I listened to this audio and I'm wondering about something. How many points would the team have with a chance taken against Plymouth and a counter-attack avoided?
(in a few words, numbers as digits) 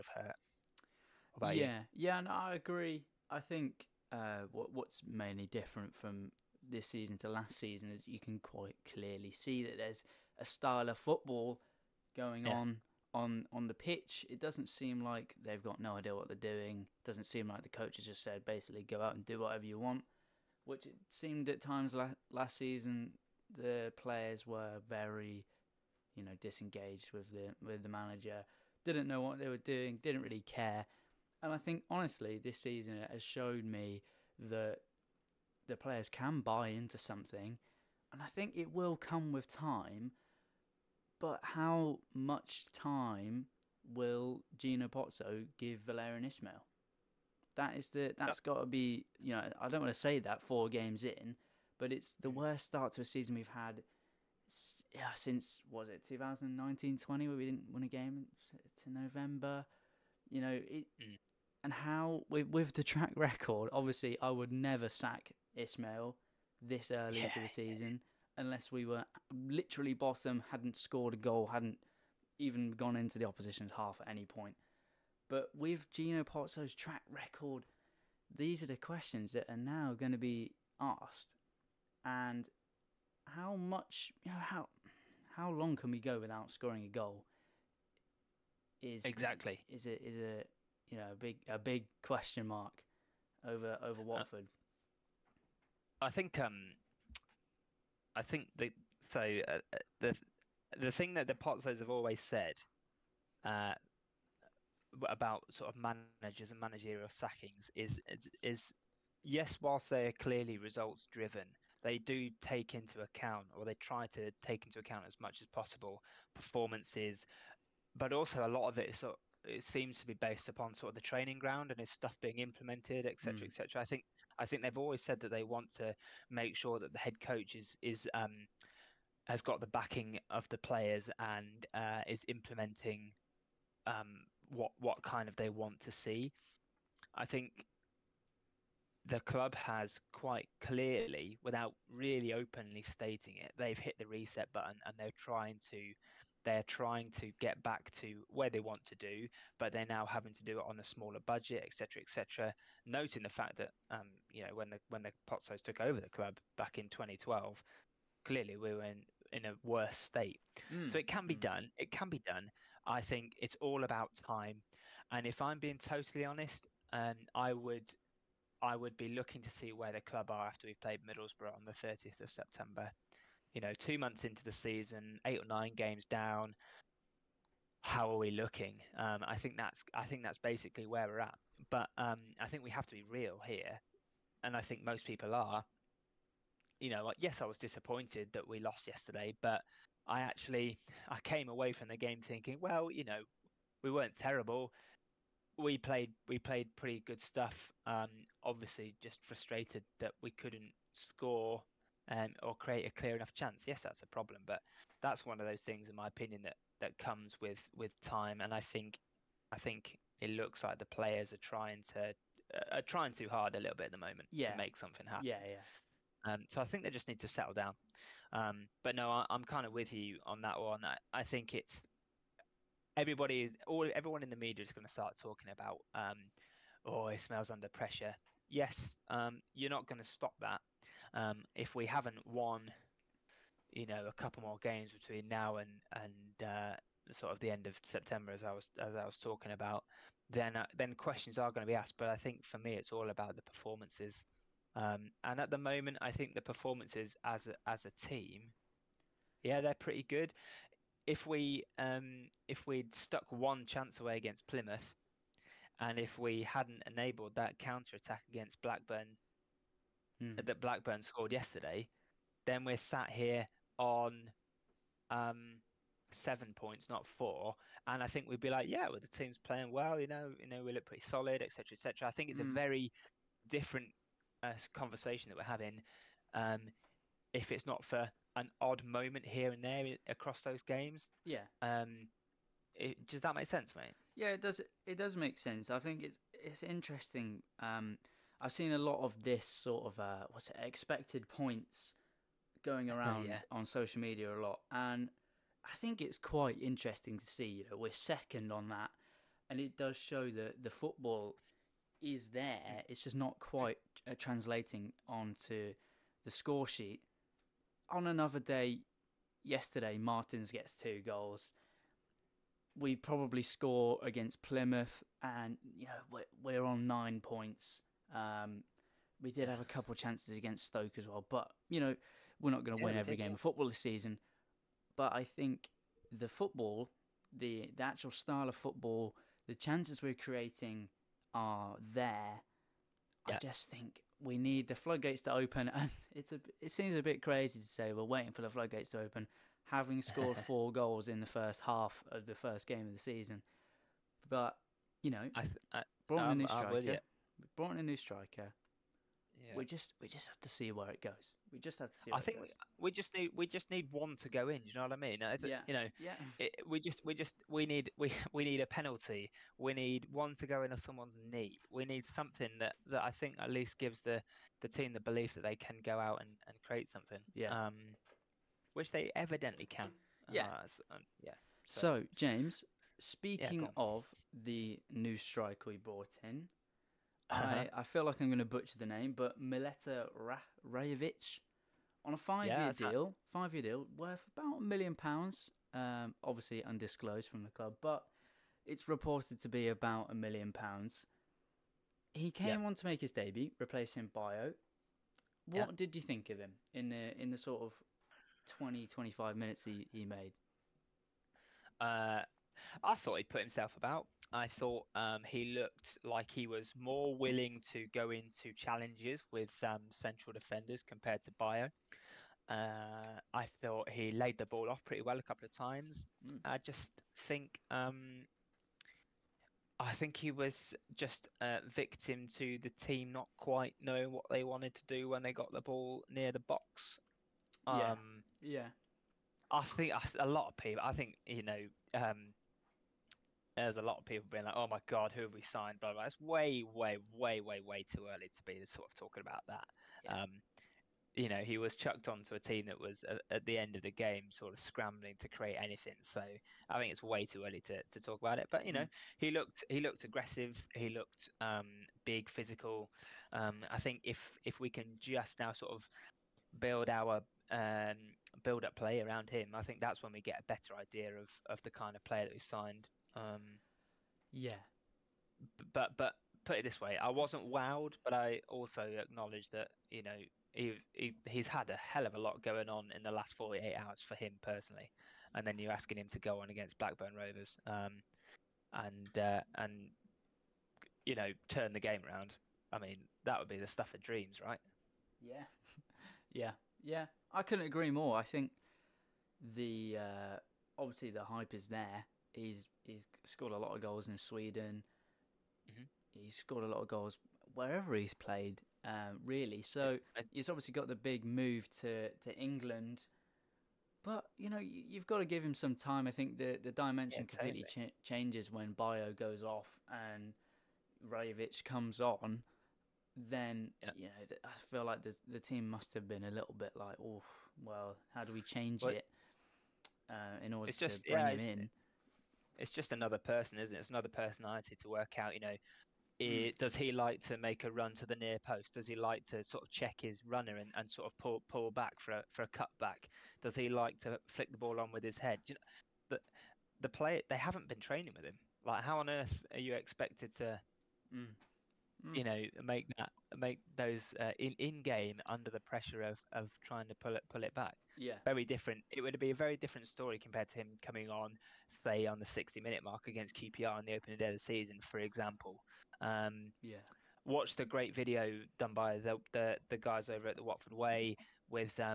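7.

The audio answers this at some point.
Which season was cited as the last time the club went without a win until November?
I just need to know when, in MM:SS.
00:56.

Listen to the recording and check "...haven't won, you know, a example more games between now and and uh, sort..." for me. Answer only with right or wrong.
wrong.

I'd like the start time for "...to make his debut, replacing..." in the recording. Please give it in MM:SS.
06:32.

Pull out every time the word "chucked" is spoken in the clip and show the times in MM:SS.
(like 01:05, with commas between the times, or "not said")
07:21.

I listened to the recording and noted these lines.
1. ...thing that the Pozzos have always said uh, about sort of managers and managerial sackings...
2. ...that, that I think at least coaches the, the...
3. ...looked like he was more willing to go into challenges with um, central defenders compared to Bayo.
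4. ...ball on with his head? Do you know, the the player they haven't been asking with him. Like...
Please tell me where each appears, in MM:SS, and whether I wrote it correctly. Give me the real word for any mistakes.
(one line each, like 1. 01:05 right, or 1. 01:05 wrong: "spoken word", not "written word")
1. 01:40 right
2. 06:02 wrong: "gives", not "coaches"
3. 06:45 right
4. 08:54 wrong: "training", not "asking".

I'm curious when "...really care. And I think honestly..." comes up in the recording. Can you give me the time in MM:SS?
00:30.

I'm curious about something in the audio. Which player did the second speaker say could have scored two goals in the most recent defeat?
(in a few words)
Martins.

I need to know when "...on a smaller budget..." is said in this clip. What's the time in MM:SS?
02:30.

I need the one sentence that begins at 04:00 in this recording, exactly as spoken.
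Then uh, then questions are going to be asked.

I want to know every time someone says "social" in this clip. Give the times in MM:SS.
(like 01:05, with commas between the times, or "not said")
04:53.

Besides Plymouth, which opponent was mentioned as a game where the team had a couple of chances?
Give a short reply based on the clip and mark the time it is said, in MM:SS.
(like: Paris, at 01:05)
Stoke, at 05:20.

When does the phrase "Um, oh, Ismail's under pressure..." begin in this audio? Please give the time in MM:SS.
03:45.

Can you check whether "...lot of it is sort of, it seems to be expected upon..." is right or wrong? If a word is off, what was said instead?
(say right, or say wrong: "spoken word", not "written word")
wrong: "based", not "expected".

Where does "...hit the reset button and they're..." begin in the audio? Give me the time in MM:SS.
02:23.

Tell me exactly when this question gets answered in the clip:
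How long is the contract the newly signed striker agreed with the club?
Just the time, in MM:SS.
06:23.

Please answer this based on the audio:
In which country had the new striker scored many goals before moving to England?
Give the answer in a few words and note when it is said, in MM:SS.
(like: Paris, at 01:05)
Sweden, at 08:14.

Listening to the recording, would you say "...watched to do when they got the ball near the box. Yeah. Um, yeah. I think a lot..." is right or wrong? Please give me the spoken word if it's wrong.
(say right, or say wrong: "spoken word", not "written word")
wrong: "wanted", not "watched".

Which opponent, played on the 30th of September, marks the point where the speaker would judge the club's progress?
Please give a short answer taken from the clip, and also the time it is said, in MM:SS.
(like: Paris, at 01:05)
Middlesbrough, at 02:51.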